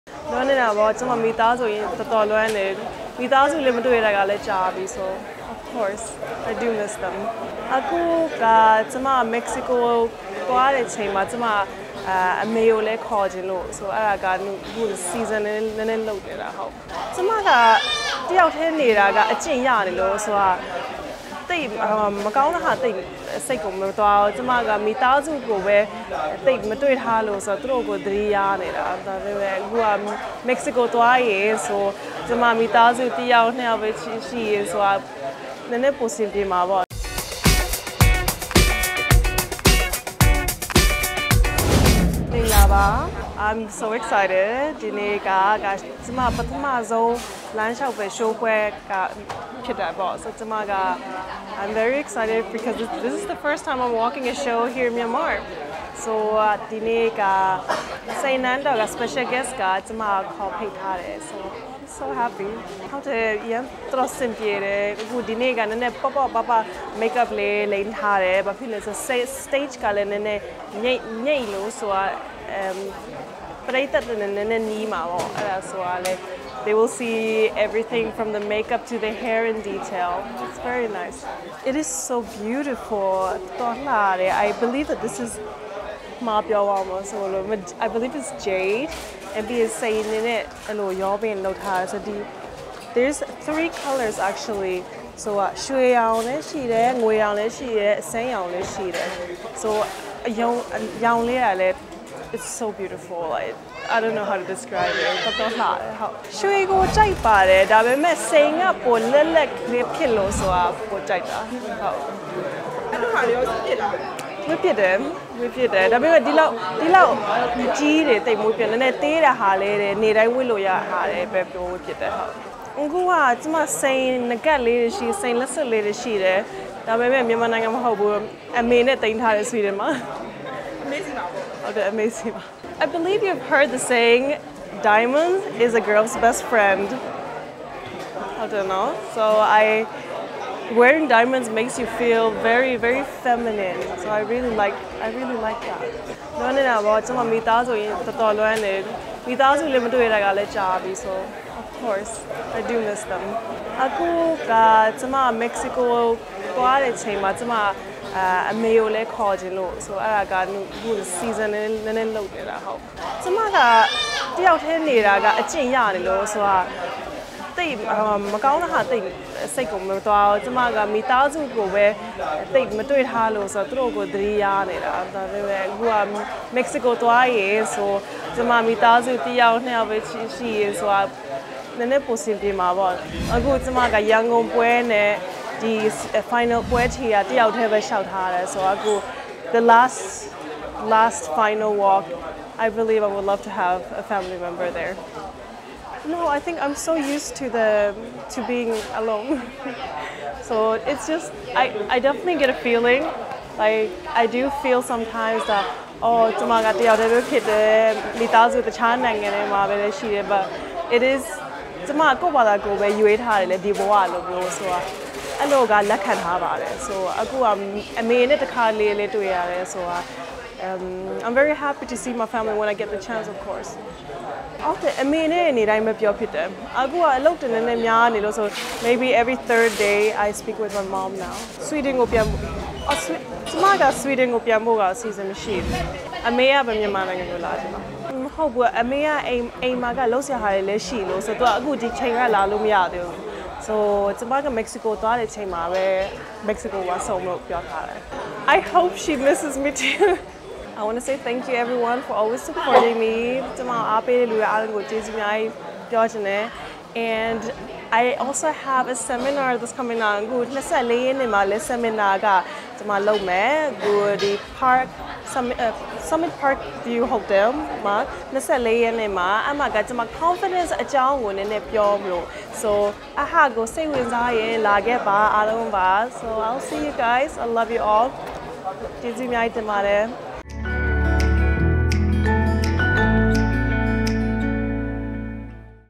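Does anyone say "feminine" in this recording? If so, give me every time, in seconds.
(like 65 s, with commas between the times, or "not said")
143 s.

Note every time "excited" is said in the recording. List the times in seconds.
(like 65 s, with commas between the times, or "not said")
44 s, 52 s.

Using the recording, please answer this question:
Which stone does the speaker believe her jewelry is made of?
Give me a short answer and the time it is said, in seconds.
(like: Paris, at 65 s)
jade, at 87 s.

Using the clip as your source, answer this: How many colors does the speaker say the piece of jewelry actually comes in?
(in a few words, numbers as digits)
3.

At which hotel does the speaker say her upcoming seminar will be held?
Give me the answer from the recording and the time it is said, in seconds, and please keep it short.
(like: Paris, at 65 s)
Summit Park View Hotel, at 266 s.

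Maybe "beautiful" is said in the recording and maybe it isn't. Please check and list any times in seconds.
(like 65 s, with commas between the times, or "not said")
82 s, 102 s.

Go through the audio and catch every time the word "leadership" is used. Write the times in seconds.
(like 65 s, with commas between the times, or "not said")
not said.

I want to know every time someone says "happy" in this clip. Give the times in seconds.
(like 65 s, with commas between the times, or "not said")
62 s, 221 s.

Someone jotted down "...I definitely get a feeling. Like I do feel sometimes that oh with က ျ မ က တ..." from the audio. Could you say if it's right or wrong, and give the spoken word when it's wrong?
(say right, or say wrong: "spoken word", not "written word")
right.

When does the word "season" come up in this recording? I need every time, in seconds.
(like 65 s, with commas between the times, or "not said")
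15 s, 161 s, 235 s.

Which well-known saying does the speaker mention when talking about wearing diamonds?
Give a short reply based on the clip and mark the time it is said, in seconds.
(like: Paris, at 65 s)
diamond is a girl's best friend, at 134 s.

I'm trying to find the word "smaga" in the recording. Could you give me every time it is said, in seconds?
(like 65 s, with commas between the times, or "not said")
233 s.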